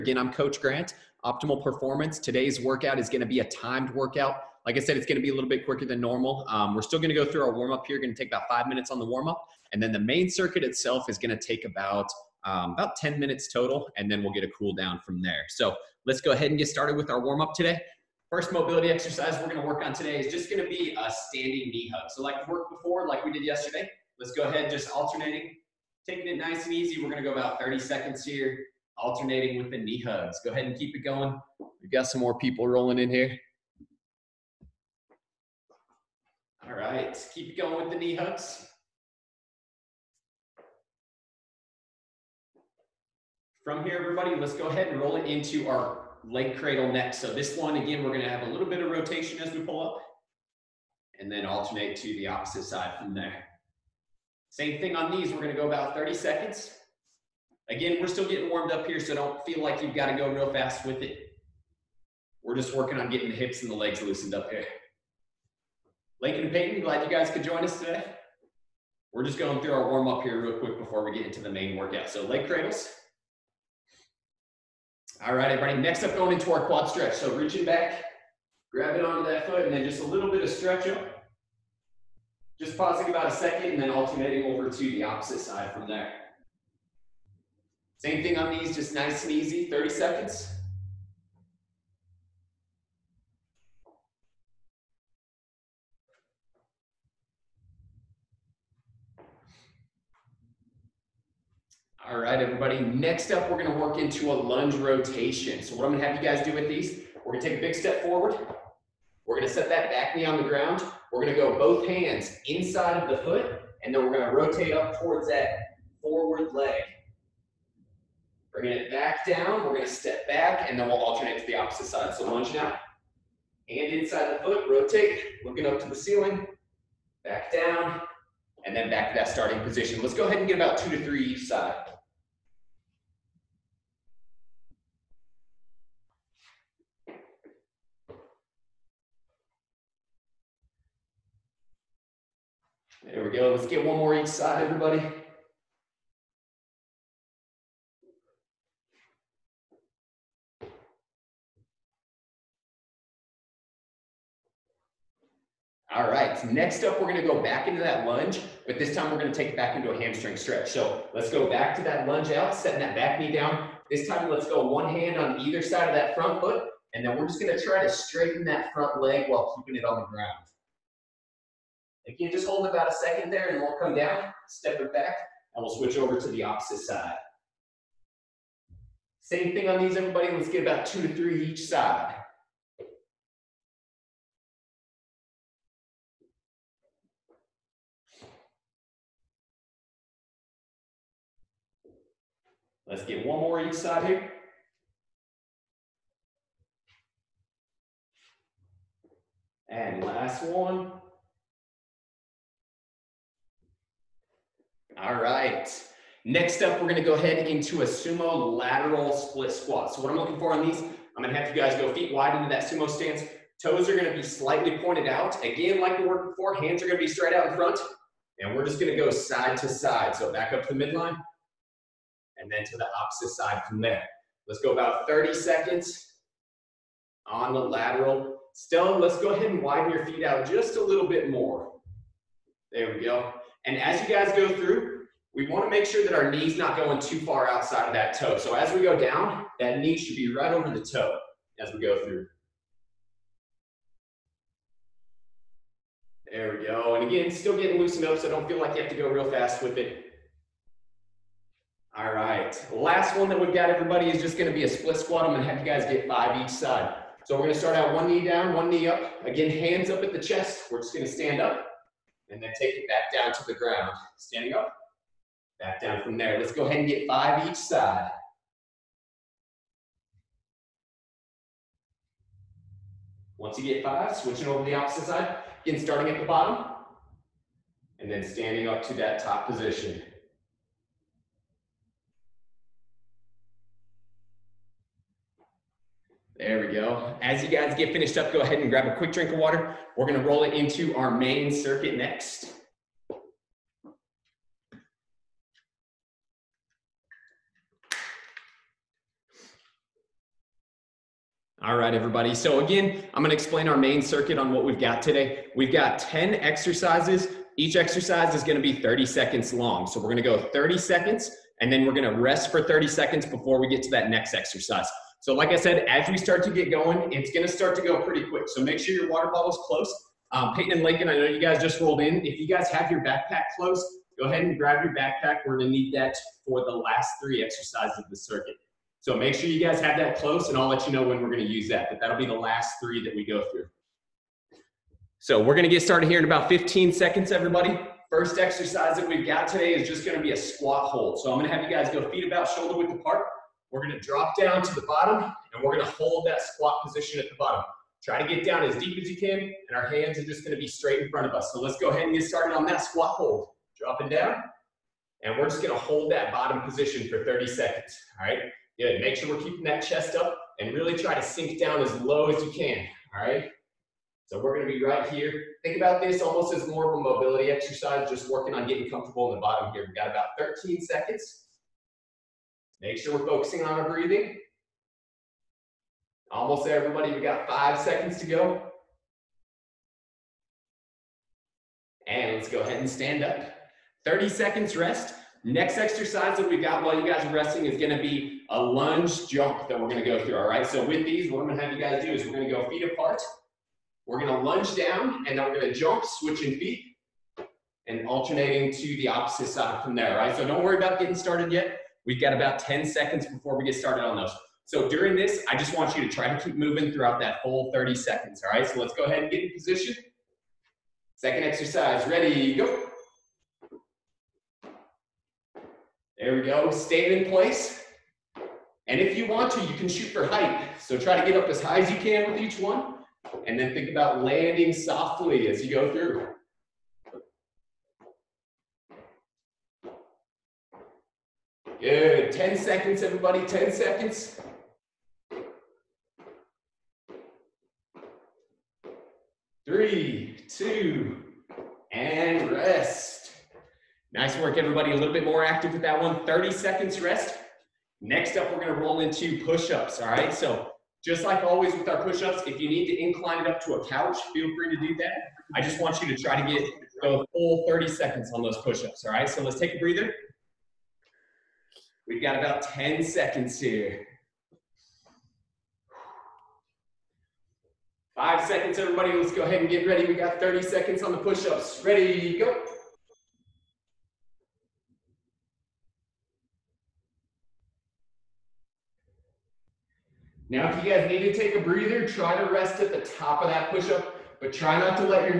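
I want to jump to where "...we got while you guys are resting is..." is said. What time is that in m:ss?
6:26.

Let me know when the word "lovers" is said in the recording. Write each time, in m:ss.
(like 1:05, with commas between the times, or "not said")
not said.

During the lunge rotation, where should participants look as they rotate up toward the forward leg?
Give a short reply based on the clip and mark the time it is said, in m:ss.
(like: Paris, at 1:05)
The ceiling, at 2:05.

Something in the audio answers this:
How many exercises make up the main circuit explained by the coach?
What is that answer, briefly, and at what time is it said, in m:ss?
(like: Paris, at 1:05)
10, at 5:05.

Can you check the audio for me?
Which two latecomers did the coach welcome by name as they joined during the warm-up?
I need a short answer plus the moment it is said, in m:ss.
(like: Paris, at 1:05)
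Lincoln and Peyton, at 1:06.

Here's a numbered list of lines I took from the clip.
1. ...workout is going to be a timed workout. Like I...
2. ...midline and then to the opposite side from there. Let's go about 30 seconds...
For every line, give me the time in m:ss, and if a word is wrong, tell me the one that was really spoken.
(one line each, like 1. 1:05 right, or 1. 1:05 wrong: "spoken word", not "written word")
1. 0:02 right
2. 3:40 right.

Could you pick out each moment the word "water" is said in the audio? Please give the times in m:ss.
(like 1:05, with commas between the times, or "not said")
4:49, 5:19.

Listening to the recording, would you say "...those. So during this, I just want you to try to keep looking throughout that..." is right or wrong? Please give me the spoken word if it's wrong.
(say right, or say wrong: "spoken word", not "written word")
wrong: "moving", not "looking".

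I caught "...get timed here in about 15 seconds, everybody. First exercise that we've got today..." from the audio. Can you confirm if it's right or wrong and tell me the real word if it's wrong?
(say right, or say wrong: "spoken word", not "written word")
wrong: "started", not "timed".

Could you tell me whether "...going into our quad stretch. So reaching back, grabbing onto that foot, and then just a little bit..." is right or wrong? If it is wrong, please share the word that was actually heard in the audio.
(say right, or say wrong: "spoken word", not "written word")
right.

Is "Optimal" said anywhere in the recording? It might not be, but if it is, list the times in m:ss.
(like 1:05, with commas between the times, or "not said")
0:01.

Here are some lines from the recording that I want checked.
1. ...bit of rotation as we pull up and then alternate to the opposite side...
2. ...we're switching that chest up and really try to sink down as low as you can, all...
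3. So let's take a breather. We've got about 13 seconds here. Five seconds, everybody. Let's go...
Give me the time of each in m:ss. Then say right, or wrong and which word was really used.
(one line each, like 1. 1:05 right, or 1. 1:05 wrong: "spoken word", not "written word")
1. 0:48 right
2. 5:59 wrong: "keeping", not "switching"
3. 7:39 wrong: "10", not "13".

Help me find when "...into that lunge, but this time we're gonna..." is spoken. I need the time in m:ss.
2:37.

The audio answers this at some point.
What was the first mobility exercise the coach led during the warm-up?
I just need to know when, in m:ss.
0:21.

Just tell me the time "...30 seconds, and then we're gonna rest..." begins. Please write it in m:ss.
5:10.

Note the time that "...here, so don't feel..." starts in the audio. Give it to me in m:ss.
0:58.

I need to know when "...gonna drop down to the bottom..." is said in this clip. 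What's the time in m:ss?
5:43.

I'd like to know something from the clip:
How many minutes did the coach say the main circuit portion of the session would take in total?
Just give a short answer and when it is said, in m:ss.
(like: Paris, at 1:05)
10, at 0:12.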